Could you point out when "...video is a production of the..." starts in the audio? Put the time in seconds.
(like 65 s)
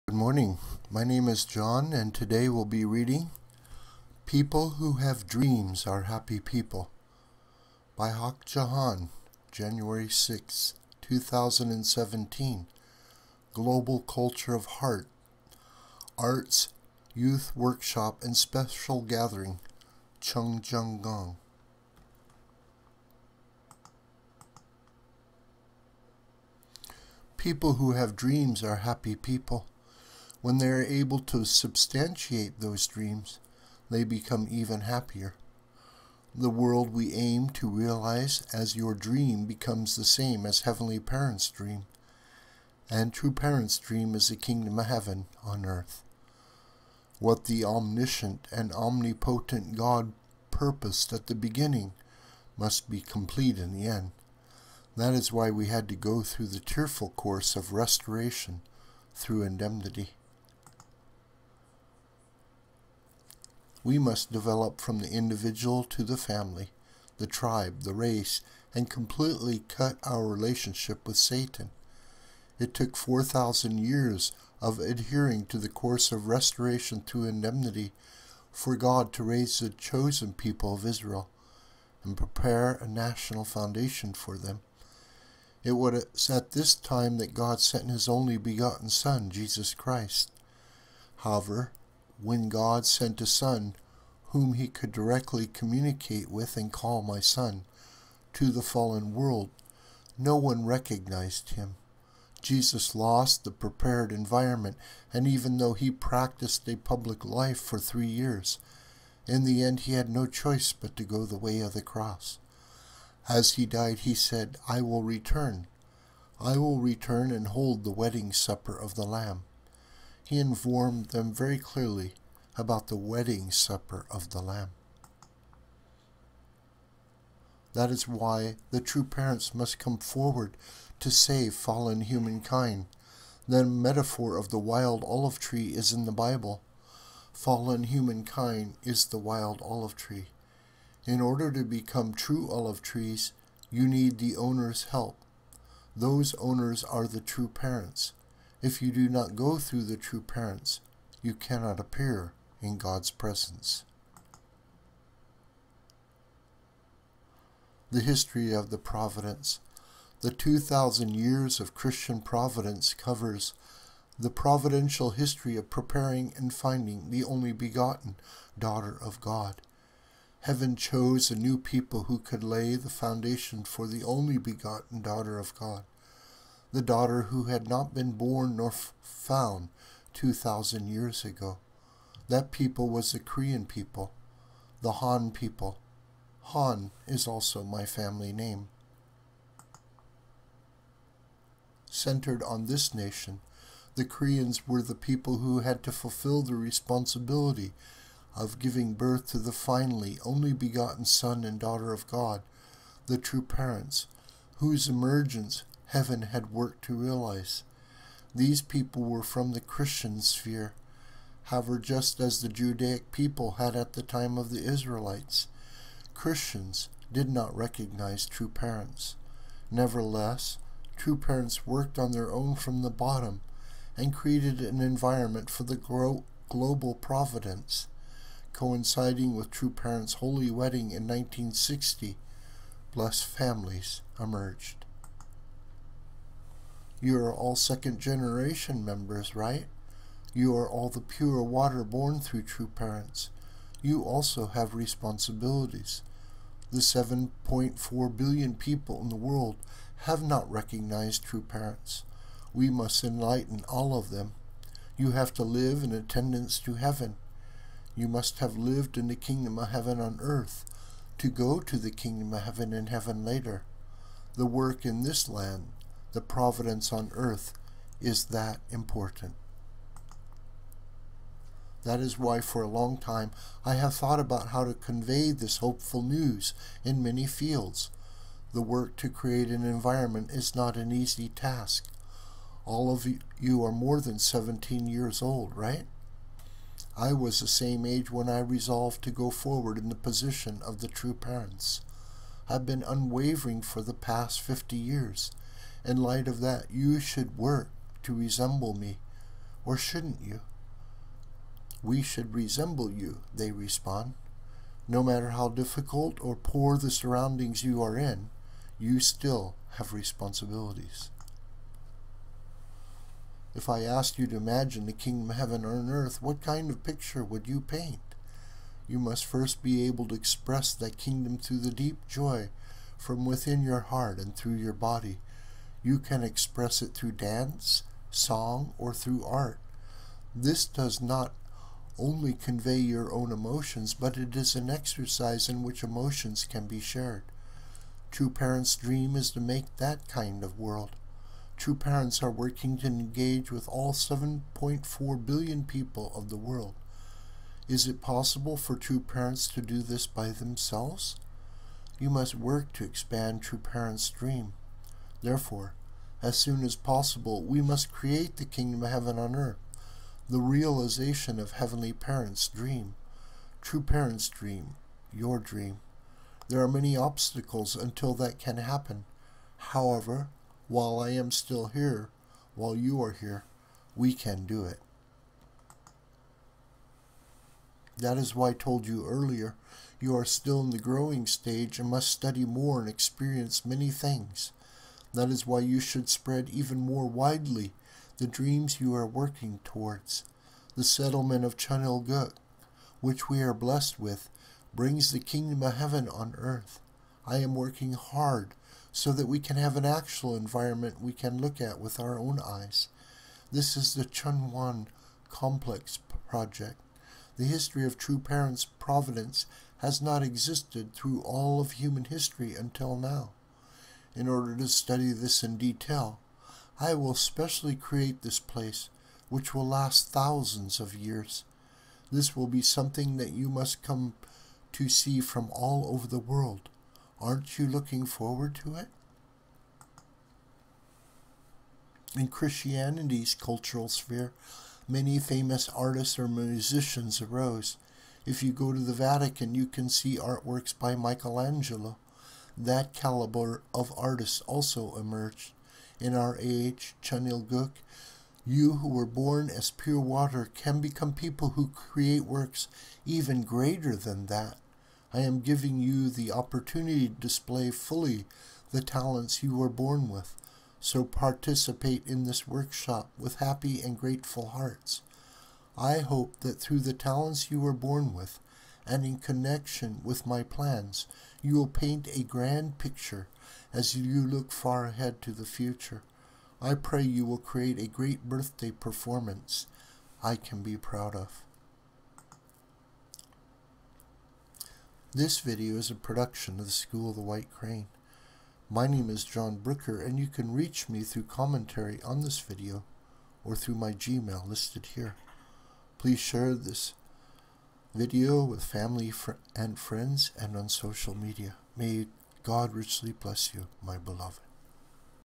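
485 s.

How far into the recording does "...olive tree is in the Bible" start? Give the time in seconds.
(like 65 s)
135 s.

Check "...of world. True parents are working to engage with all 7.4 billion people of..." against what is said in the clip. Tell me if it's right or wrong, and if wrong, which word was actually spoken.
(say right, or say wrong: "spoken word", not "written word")
right.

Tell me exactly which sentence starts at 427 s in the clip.
Aren't you looking forward to it?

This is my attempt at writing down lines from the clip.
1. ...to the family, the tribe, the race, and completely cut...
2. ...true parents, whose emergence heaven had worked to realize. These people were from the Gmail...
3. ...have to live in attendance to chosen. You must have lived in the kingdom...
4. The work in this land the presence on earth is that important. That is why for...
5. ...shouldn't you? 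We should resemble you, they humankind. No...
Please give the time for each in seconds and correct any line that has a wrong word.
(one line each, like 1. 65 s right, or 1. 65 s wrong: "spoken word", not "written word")
1. 65 s right
2. 203 s wrong: "Christian", not "Gmail"
3. 255 s wrong: "heaven", not "chosen"
4. 264 s wrong: "providence", not "presence"
5. 299 s wrong: "respond", not "humankind".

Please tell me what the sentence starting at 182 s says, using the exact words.
That people was the Korean people, the Han people.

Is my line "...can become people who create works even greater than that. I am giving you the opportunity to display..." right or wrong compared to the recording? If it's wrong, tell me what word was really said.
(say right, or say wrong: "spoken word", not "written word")
right.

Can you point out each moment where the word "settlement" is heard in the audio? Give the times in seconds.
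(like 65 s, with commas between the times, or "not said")
390 s.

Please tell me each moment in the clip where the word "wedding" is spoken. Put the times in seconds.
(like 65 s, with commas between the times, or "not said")
117 s, 122 s, 230 s.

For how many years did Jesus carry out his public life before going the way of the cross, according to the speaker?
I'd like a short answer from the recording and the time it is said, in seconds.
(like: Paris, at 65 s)
Three years, at 107 s.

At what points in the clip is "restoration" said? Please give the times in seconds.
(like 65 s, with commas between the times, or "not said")
57 s, 76 s.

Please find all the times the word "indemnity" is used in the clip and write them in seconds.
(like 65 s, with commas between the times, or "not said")
59 s, 77 s.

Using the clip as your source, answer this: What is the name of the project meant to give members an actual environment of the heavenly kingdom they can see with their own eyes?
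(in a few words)
Cheonwon Complex Project.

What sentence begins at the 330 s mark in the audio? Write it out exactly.
This does not only convey your own emotions, but it is an exercise in which emotions can be shared.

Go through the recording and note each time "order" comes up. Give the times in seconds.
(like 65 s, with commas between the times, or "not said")
141 s, 414 s.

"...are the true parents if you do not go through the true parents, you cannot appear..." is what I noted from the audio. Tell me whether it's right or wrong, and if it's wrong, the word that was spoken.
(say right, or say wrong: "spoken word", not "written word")
right.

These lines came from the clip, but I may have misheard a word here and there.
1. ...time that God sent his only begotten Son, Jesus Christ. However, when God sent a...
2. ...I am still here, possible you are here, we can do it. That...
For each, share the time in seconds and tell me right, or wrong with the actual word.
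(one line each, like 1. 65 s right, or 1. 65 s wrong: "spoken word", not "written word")
1. 86 s right
2. 370 s wrong: "while", not "possible".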